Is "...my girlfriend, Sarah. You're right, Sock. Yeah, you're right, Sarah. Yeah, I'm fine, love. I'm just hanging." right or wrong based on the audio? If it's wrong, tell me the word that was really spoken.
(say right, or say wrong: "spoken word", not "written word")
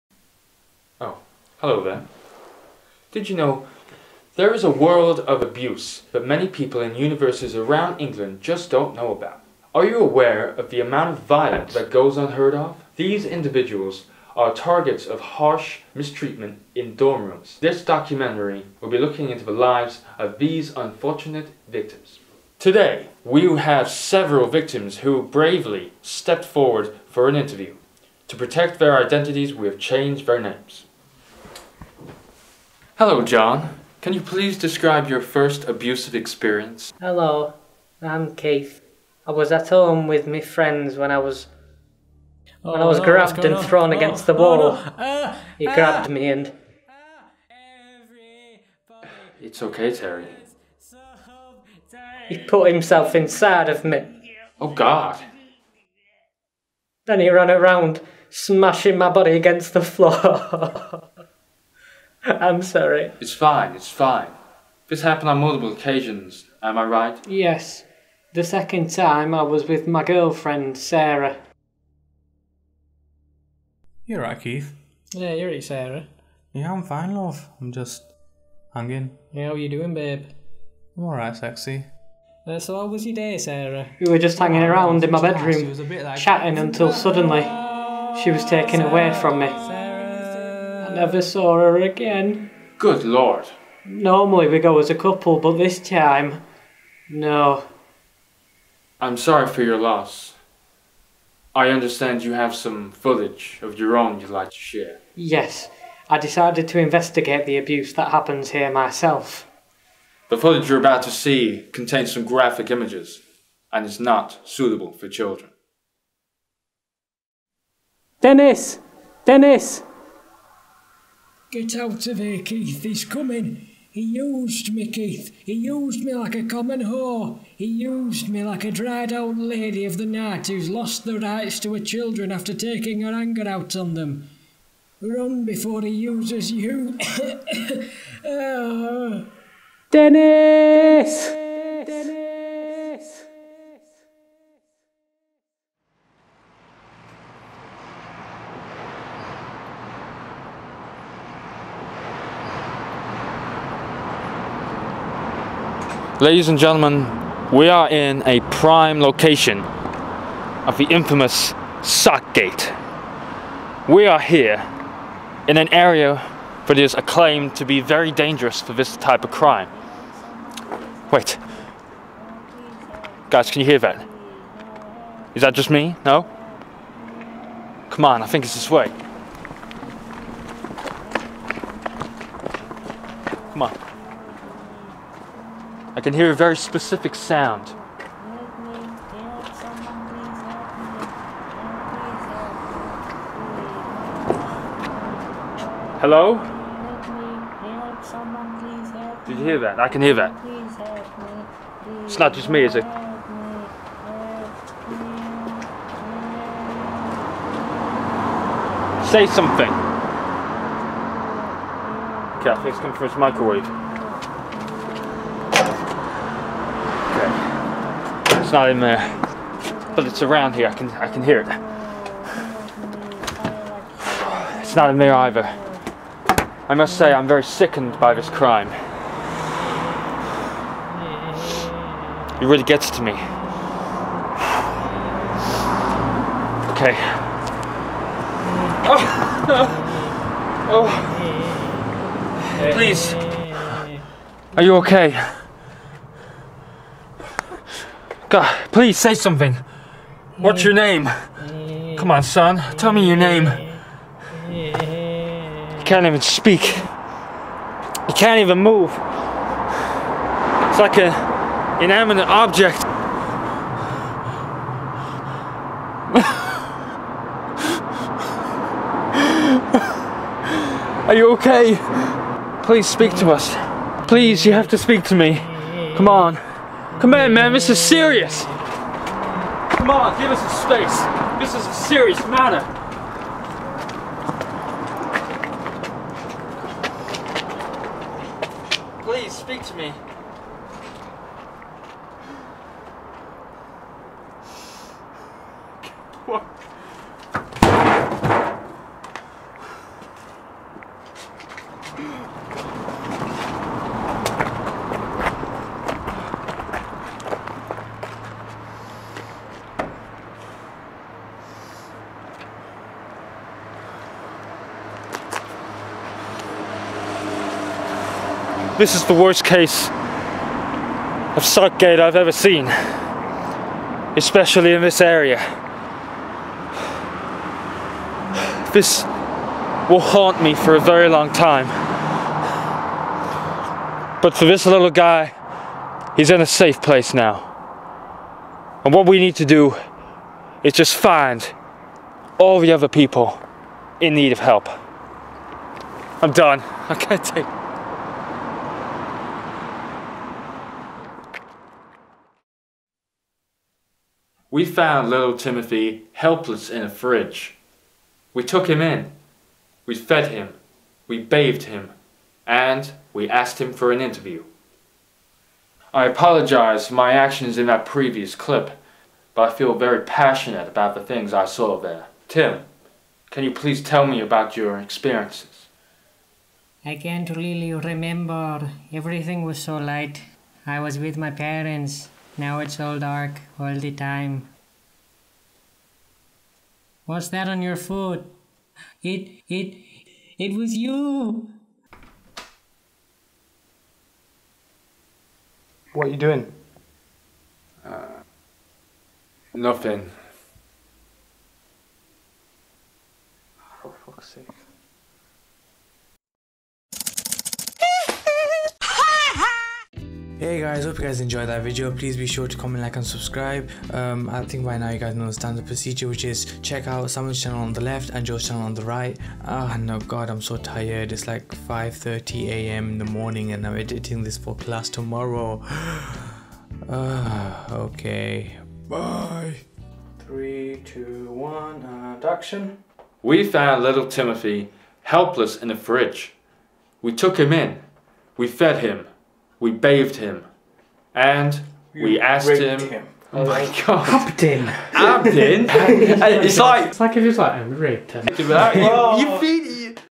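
wrong: "Keith", not "Sock".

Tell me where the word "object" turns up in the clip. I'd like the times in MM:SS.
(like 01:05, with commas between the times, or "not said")
04:22.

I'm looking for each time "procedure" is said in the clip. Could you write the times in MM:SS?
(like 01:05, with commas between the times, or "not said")
06:55.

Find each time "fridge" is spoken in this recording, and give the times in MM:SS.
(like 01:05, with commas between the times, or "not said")
05:56, 07:15.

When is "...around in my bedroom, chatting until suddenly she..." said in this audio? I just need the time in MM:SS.
01:24.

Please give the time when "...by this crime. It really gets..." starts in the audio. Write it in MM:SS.
03:47.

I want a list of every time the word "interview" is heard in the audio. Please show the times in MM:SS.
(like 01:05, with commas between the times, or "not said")
00:27, 06:04.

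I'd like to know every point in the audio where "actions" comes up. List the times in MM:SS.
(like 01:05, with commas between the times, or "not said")
06:07, 07:12.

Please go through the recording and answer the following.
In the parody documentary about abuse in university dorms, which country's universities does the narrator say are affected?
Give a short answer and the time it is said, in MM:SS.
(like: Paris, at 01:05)
England, at 00:08.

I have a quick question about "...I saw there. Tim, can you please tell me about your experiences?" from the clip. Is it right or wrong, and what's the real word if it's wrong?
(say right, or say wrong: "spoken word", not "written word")
right.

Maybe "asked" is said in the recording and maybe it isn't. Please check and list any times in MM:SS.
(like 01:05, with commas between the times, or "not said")
06:03, 07:22.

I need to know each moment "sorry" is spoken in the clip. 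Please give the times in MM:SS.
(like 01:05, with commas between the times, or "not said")
01:02, 01:39.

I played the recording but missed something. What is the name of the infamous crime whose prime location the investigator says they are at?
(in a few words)
Sock Gate.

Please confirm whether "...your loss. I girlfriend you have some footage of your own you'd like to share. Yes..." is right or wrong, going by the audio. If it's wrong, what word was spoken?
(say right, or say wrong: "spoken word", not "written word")
wrong: "understand", not "girlfriend".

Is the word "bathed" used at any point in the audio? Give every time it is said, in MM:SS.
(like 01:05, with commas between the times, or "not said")
06:01, 07:19.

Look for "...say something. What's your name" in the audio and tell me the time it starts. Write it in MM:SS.
04:08.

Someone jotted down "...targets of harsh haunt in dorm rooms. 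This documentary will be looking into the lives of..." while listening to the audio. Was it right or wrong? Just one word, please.
wrong.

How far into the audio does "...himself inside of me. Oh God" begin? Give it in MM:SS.
00:52.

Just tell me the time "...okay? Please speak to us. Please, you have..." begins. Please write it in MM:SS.
04:31.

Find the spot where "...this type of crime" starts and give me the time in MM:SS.
02:48.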